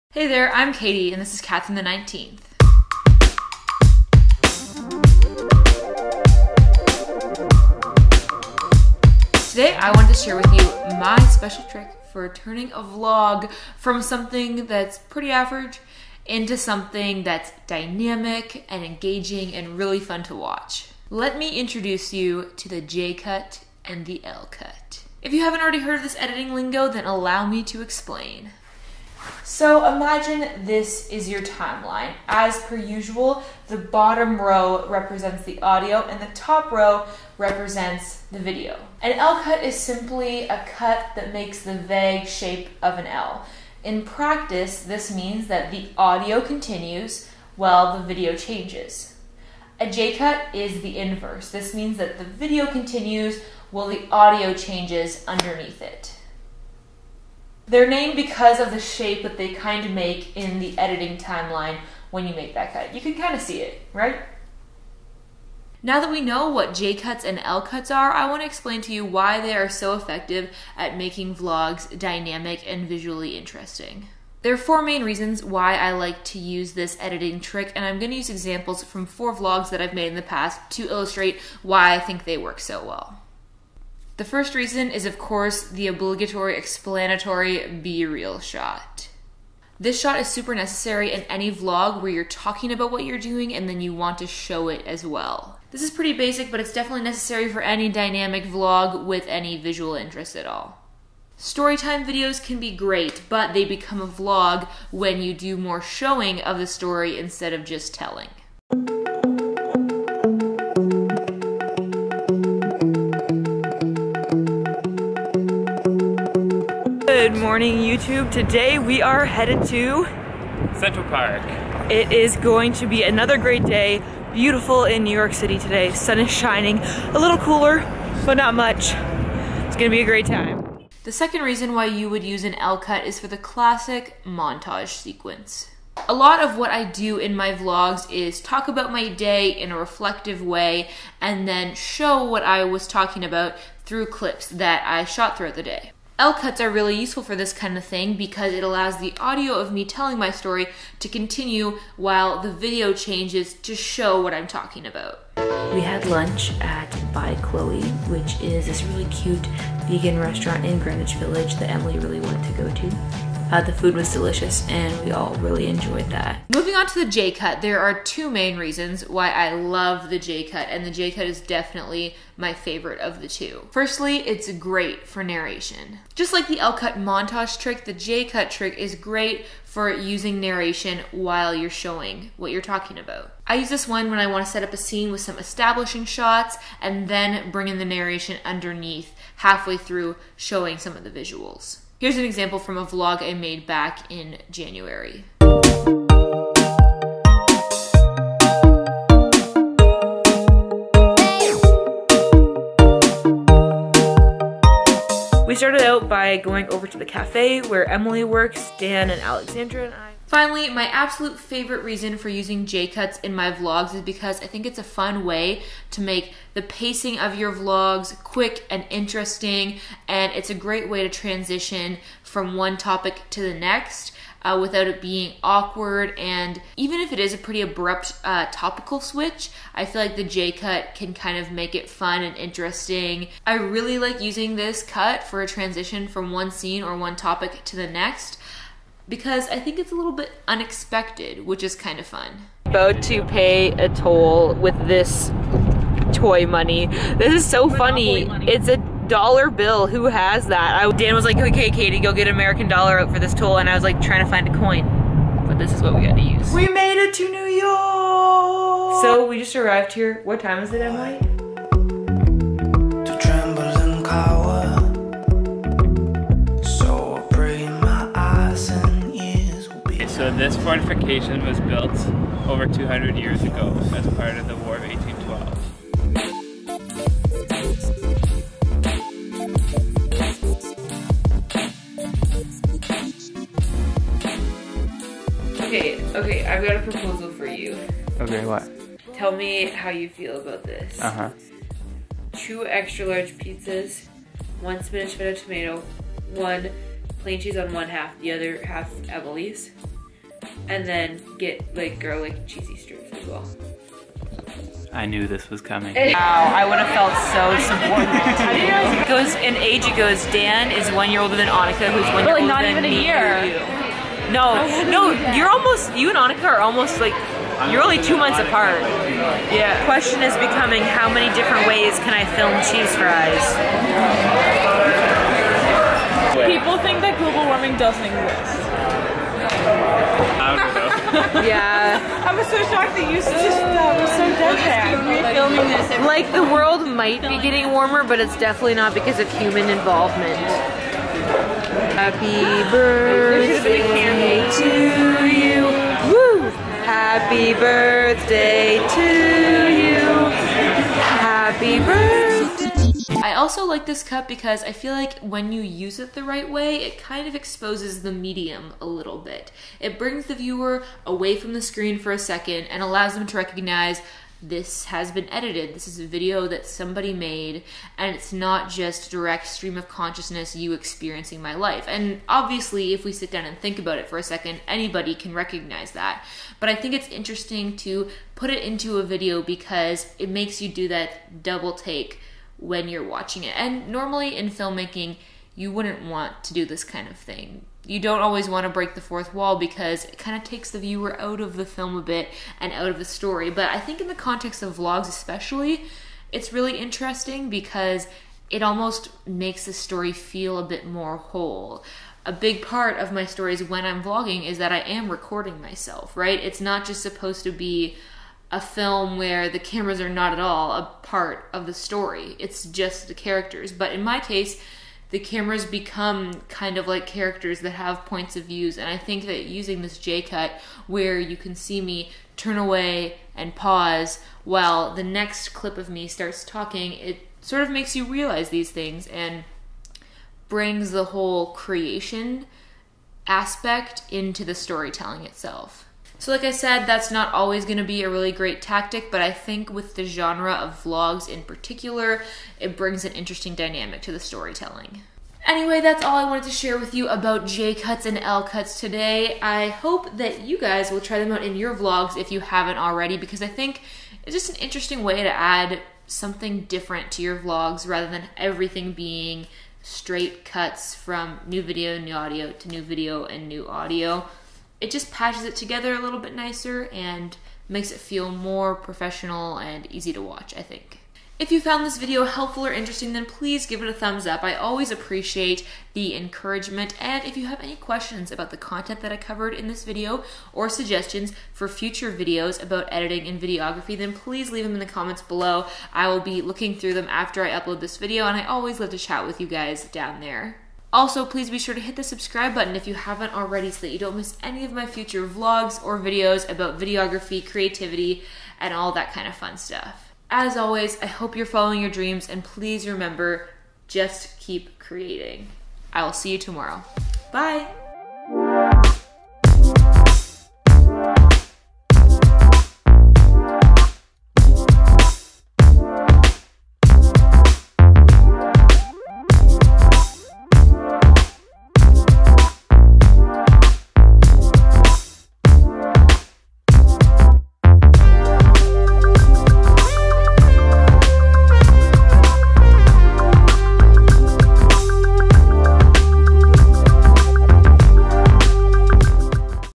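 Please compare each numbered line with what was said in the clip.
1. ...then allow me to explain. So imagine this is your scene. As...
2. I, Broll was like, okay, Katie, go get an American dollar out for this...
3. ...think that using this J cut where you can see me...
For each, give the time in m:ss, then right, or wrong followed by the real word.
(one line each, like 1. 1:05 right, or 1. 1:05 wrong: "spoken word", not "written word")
1. 0:26 wrong: "timeline", not "scene"
2. 4:10 wrong: "Dan", not "Broll"
3. 6:58 right.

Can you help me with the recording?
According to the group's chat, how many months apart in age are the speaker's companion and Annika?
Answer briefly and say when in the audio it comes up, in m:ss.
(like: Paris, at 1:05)
2 months, at 5:18.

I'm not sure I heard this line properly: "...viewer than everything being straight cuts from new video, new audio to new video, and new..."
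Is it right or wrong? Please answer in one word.
wrong.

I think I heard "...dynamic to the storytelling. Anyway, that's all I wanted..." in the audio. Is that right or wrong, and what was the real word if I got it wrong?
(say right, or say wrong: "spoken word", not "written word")
right.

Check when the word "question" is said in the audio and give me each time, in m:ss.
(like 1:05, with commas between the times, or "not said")
5:19, 7:57.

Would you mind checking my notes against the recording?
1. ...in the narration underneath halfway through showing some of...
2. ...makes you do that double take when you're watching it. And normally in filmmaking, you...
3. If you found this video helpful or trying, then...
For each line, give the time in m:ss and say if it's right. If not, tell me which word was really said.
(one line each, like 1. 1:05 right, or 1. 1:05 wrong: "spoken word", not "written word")
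1. 3:07 right
2. 6:20 right
3. 7:51 wrong: "interesting", not "trying".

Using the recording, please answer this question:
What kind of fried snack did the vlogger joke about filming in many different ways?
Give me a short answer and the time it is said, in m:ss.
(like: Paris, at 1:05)
Cheese fries, at 5:22.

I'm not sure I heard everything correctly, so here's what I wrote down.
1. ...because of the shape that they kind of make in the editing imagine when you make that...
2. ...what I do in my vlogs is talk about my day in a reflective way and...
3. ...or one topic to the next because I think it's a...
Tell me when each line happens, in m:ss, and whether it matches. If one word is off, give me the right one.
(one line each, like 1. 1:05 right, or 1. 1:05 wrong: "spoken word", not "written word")
1. 0:58 wrong: "timeline", not "imagine"
2. 2:16 right
3. 3:56 right.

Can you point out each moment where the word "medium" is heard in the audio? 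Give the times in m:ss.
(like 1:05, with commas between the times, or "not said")
5:58.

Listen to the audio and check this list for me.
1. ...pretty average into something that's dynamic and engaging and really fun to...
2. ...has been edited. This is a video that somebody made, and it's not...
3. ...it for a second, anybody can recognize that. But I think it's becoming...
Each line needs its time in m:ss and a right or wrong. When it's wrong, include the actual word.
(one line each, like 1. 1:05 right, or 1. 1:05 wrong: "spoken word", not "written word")
1. 0:14 right
2. 6:04 right
3. 6:13 wrong: "interesting", not "becoming".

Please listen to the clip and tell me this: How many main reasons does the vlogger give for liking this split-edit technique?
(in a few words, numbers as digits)
4.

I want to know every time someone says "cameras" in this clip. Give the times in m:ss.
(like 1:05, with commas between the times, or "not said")
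6:49, 6:55.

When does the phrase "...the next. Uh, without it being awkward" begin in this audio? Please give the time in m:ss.
3:43.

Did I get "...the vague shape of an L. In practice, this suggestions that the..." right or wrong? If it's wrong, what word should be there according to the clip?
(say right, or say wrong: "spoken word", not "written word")
wrong: "means", not "suggestions".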